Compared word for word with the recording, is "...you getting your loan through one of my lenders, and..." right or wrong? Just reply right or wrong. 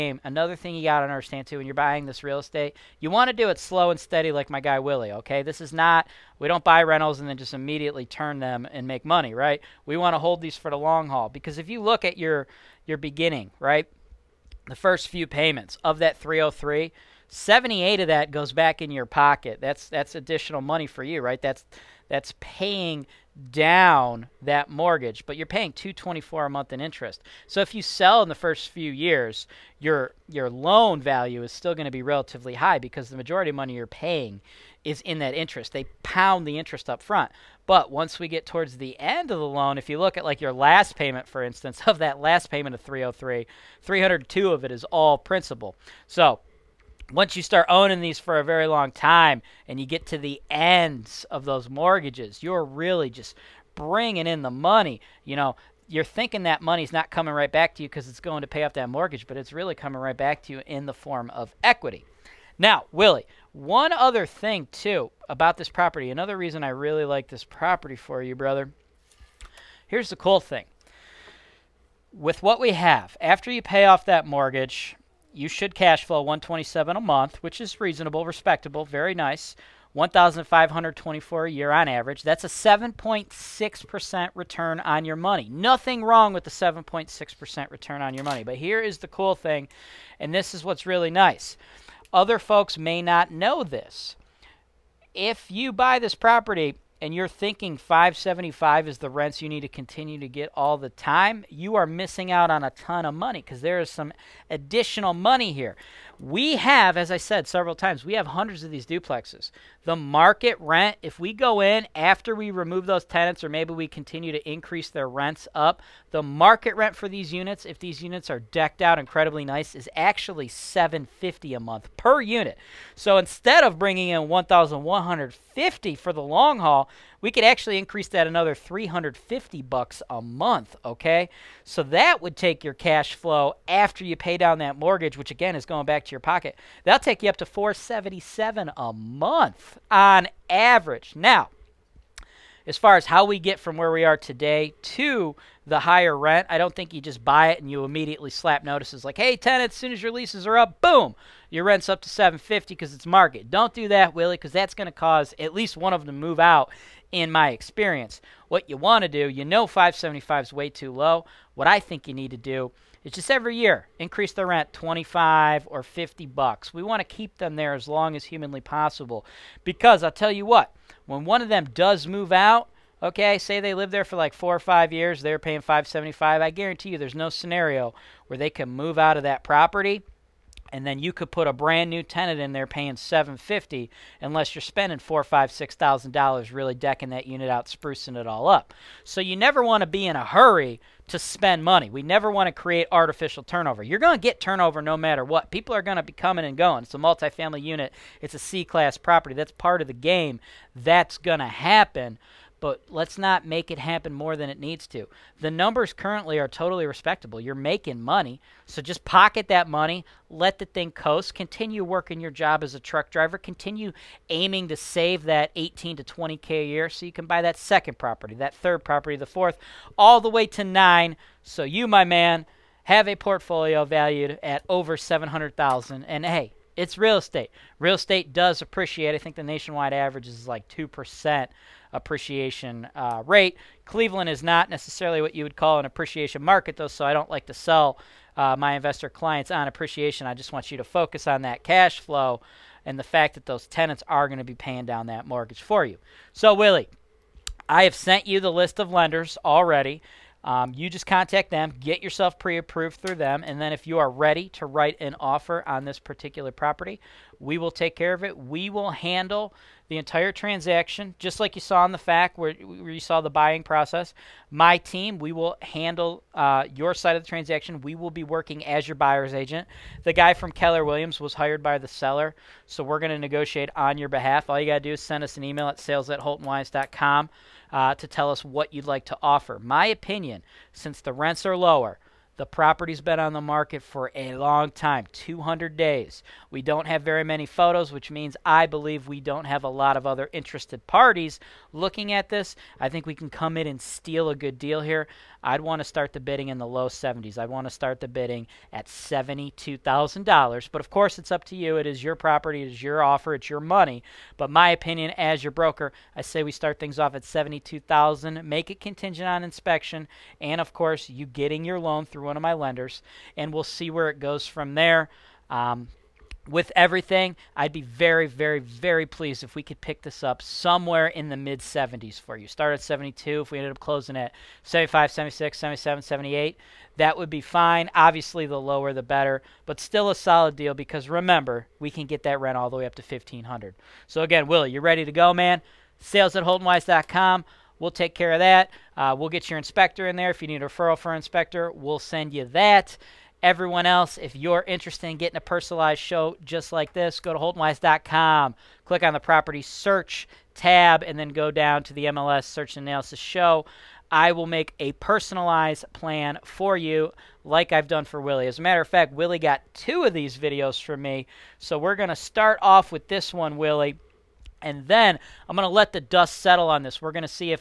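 right.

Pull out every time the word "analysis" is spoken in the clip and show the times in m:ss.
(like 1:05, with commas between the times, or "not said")
5:52.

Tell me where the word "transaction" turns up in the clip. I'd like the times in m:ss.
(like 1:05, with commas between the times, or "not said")
4:20, 4:27.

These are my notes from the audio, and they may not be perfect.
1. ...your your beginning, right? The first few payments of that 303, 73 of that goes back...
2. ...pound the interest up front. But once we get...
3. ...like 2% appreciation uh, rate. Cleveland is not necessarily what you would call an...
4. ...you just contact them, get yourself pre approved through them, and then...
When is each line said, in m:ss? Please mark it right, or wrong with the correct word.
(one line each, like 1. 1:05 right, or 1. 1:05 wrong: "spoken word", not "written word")
1. 0:12 wrong: "78", not "73"
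2. 0:36 right
3. 3:50 right
4. 4:10 right.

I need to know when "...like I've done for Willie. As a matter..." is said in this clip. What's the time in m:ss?
5:57.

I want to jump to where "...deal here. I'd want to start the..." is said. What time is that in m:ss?
4:54.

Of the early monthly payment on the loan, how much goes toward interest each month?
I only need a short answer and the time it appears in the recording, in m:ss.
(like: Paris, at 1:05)
224, at 0:25.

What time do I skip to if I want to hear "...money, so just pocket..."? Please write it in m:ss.
3:28.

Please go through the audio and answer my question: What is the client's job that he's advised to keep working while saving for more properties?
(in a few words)
truck driver.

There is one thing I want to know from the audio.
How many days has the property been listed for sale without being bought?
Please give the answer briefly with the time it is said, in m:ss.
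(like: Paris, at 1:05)
200 days, at 4:45.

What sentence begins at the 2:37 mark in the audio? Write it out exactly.
In my experience, what you want to do, you know, 575 is way too low.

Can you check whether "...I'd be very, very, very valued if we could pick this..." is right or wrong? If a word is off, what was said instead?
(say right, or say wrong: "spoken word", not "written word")
wrong: "pleased", not "valued".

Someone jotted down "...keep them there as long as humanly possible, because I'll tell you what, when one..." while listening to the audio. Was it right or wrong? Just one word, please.
right.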